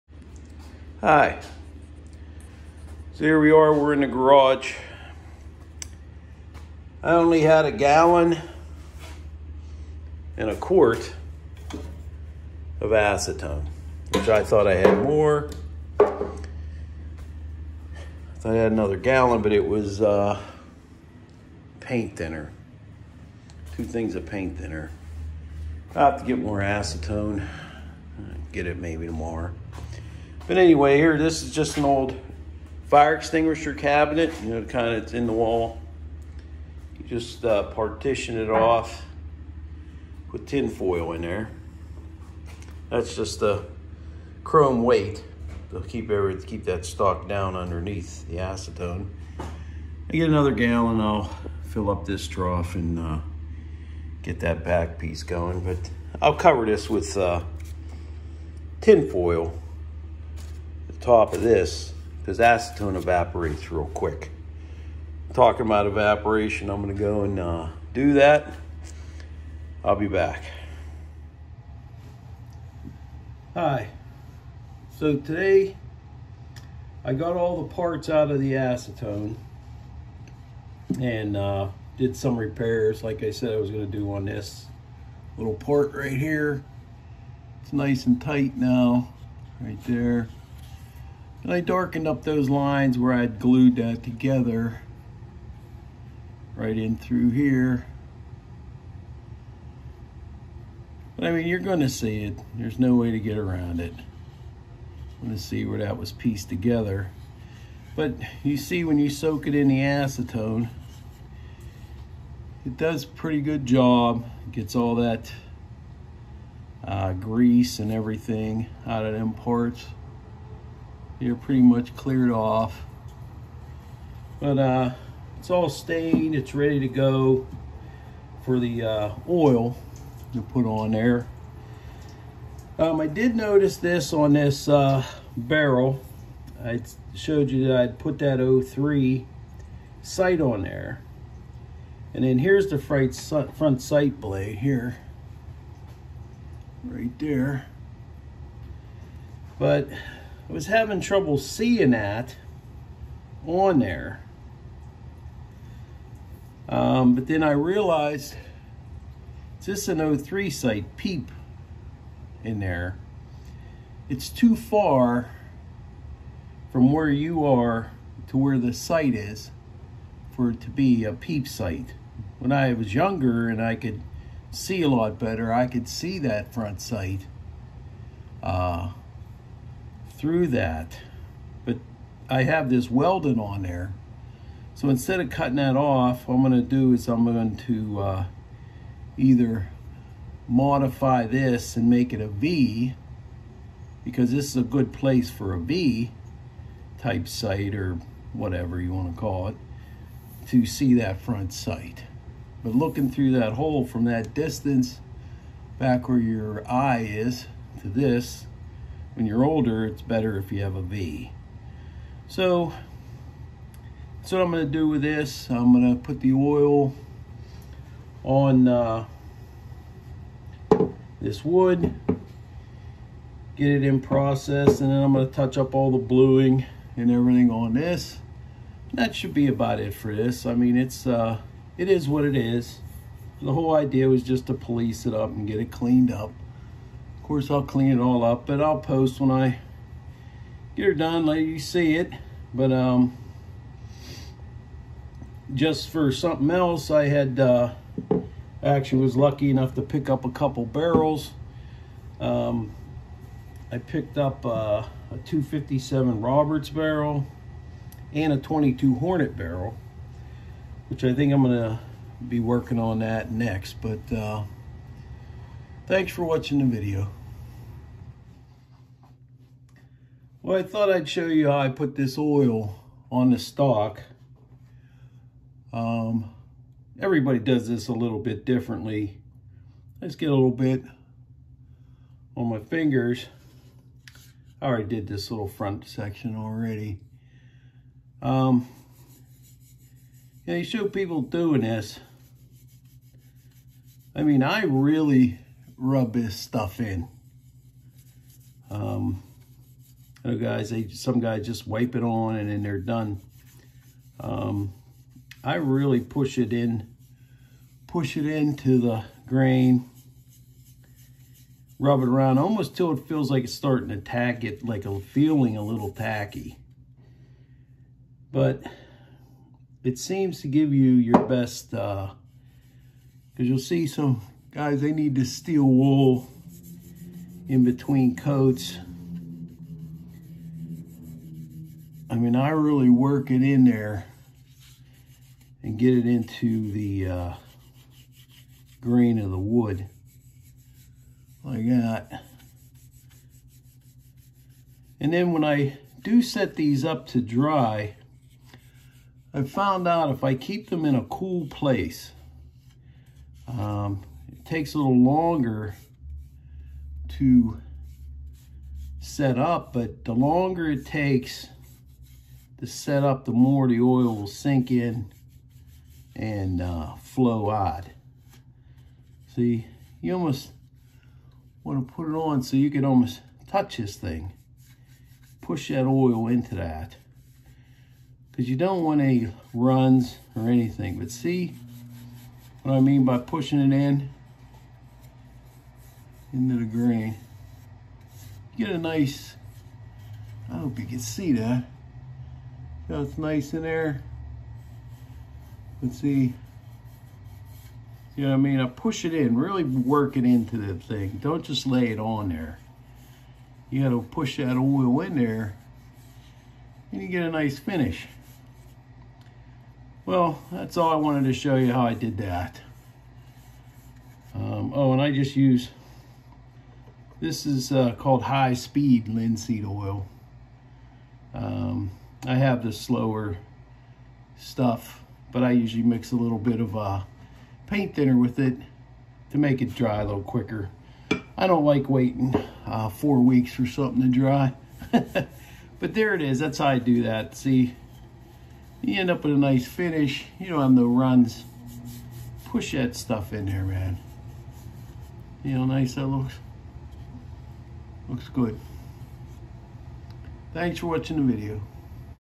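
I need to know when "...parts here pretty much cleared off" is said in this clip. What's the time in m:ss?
1:59.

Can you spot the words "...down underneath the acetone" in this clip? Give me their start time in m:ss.
0:47.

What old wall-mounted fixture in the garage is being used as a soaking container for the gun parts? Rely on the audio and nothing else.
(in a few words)
fire extinguisher cabinet.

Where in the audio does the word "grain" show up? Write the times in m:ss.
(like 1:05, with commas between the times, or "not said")
5:09, 5:38, 6:26.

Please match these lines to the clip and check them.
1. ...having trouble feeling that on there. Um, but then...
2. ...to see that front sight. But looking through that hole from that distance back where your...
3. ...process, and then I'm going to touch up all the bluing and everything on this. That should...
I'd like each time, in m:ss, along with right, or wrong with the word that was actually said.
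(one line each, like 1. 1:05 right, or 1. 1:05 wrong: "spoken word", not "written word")
1. 2:30 wrong: "seeing", not "feeling"
2. 3:20 right
3. 3:44 right.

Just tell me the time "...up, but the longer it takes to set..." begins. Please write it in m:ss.
5:59.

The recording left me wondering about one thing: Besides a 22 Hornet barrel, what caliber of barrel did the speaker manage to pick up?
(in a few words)
257 Roberts.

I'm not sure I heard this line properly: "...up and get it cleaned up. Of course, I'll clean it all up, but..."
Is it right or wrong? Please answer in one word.
right.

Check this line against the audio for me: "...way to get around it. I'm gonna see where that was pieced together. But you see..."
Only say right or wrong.
right.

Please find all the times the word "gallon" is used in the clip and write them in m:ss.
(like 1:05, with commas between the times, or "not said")
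0:07, 0:18, 0:50.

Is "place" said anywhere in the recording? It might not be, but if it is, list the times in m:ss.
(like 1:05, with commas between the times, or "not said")
3:14, 5:51.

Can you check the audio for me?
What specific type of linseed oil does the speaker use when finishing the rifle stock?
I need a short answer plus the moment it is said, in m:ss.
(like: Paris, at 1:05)
high speed linseed oil, at 6:58.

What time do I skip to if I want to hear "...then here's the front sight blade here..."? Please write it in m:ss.
2:22.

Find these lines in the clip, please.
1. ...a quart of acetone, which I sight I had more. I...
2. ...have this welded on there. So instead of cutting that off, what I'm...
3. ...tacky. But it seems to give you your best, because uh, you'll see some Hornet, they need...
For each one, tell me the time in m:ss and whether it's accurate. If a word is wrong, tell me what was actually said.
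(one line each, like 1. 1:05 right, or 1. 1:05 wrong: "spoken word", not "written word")
1. 0:10 wrong: "thought", not "sight"
2. 3:02 right
3. 5:15 wrong: "Guys", not "Hornet".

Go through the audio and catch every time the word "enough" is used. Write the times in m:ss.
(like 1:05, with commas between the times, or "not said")
4:09.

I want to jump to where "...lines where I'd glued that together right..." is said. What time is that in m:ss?
1:32.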